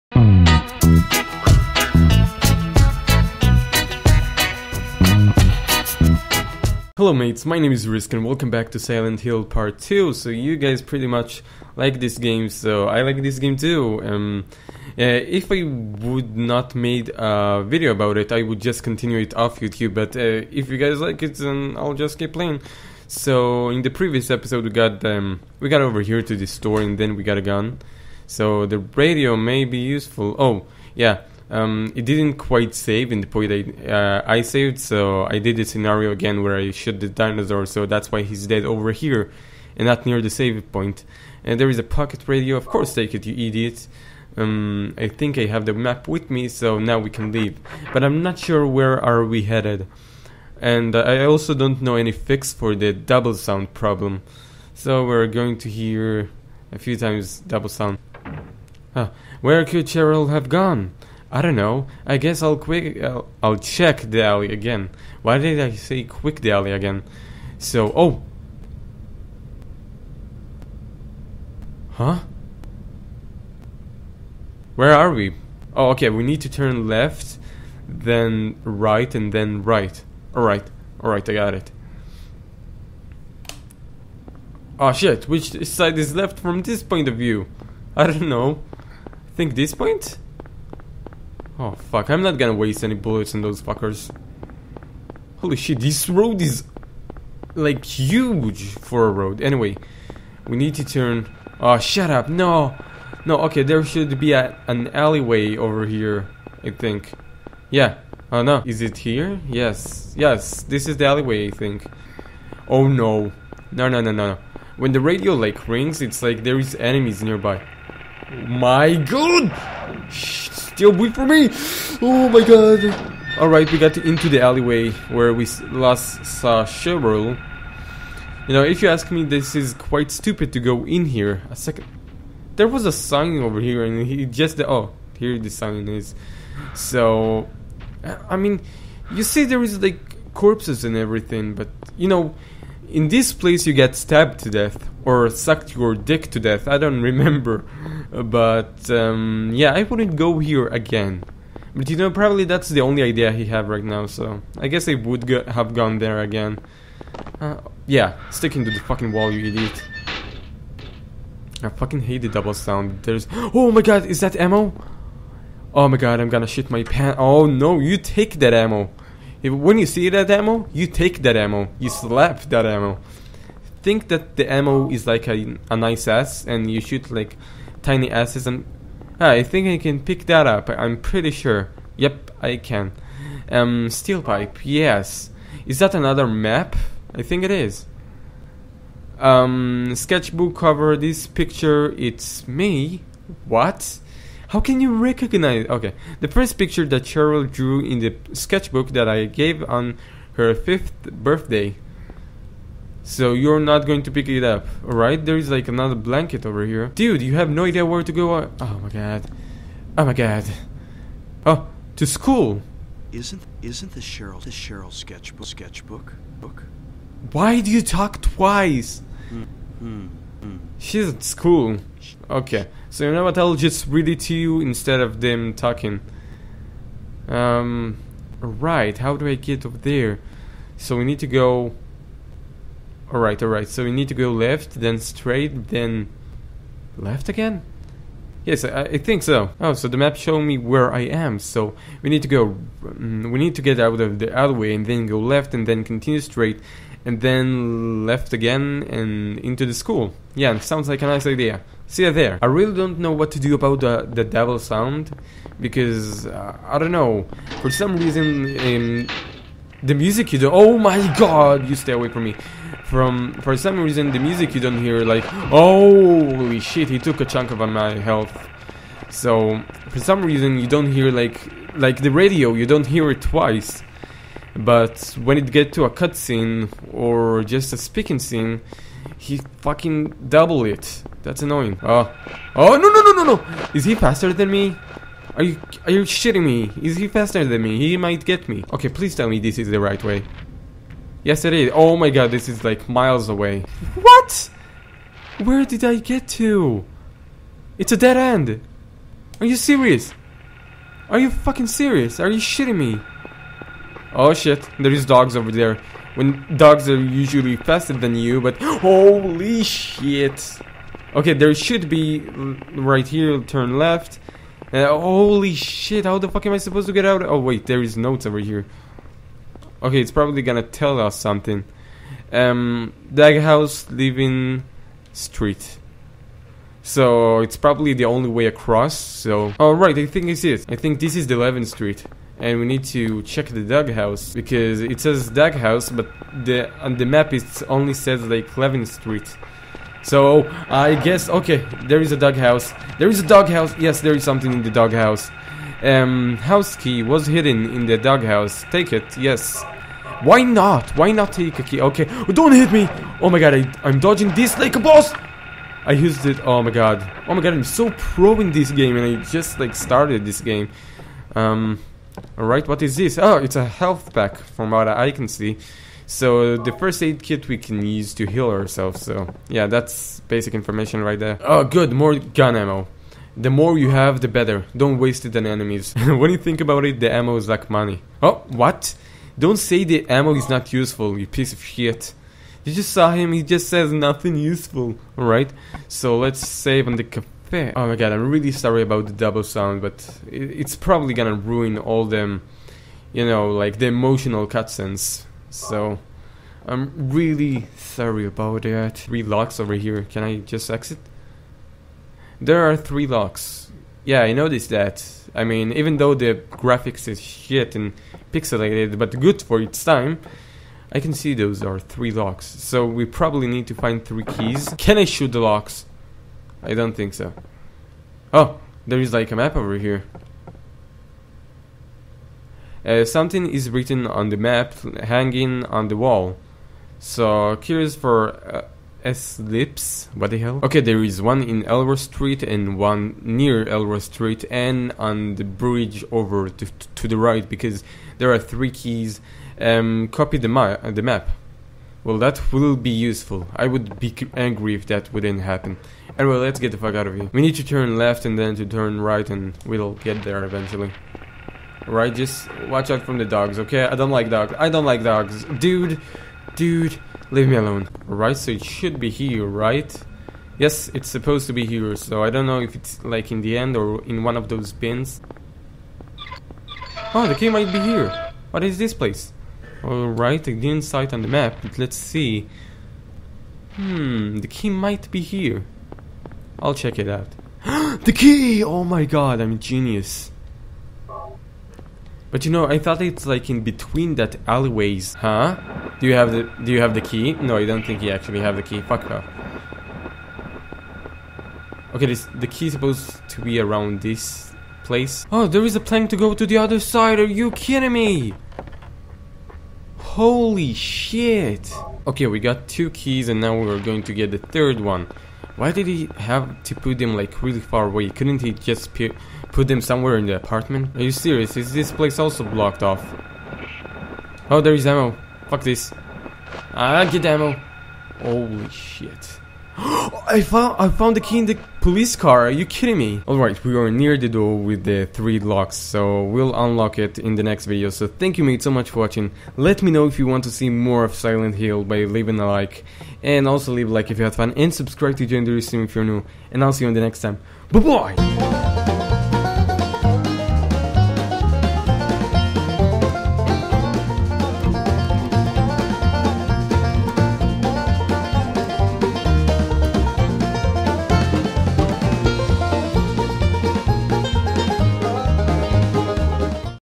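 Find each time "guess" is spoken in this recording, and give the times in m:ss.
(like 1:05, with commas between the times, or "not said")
1:02, 2:34, 5:40.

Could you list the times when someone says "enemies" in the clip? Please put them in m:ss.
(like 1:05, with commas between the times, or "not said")
1:56, 6:15.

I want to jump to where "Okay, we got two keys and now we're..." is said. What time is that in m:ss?
8:22.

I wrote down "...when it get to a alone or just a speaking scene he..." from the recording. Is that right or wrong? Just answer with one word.
wrong.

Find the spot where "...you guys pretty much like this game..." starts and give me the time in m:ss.
0:10.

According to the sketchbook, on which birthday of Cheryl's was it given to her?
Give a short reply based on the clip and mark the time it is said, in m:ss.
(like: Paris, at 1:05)
Fifth, at 3:20.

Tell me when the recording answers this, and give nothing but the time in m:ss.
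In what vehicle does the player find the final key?
8:41.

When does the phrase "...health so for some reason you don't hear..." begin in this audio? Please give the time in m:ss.
4:28.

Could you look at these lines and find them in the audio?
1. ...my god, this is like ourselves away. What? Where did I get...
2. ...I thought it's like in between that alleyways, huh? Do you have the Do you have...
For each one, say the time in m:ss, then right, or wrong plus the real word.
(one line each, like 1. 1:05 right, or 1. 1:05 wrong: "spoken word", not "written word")
1. 4:51 wrong: "miles", not "ourselves"
2. 8:02 right.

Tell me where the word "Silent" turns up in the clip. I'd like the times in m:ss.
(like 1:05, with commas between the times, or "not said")
0:08, 8:51.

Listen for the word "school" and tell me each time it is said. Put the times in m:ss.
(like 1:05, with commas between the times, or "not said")
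3:32, 3:41, 4:09.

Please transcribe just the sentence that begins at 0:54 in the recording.
So we're going to hear a few times double sound.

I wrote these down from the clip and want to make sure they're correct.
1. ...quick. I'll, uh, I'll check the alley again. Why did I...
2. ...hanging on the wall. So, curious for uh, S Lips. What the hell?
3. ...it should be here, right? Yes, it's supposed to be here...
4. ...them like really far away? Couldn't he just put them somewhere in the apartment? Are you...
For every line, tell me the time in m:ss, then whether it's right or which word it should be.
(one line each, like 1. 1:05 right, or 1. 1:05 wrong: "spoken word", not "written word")
1. 1:02 right
2. 7:05 right
3. 7:38 right
4. 8:26 right.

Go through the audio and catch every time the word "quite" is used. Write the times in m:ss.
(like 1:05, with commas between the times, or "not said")
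0:32, 2:09.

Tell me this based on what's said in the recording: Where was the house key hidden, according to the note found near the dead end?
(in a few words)
The doghouse.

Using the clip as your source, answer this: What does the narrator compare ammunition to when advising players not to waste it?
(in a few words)
Money.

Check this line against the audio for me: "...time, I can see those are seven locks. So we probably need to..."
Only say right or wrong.
wrong.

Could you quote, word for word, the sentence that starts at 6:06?
So the first aid kit we can use to heal ourselves.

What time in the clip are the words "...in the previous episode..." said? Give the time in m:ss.
0:23.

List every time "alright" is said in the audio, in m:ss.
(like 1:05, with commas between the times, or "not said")
2:03, 3:24, 5:29, 6:02, 6:25, 7:49, 8:43.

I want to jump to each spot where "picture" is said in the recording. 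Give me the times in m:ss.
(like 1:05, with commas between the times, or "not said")
3:11, 3:16.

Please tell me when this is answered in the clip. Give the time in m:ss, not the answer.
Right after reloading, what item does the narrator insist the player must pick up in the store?
0:41.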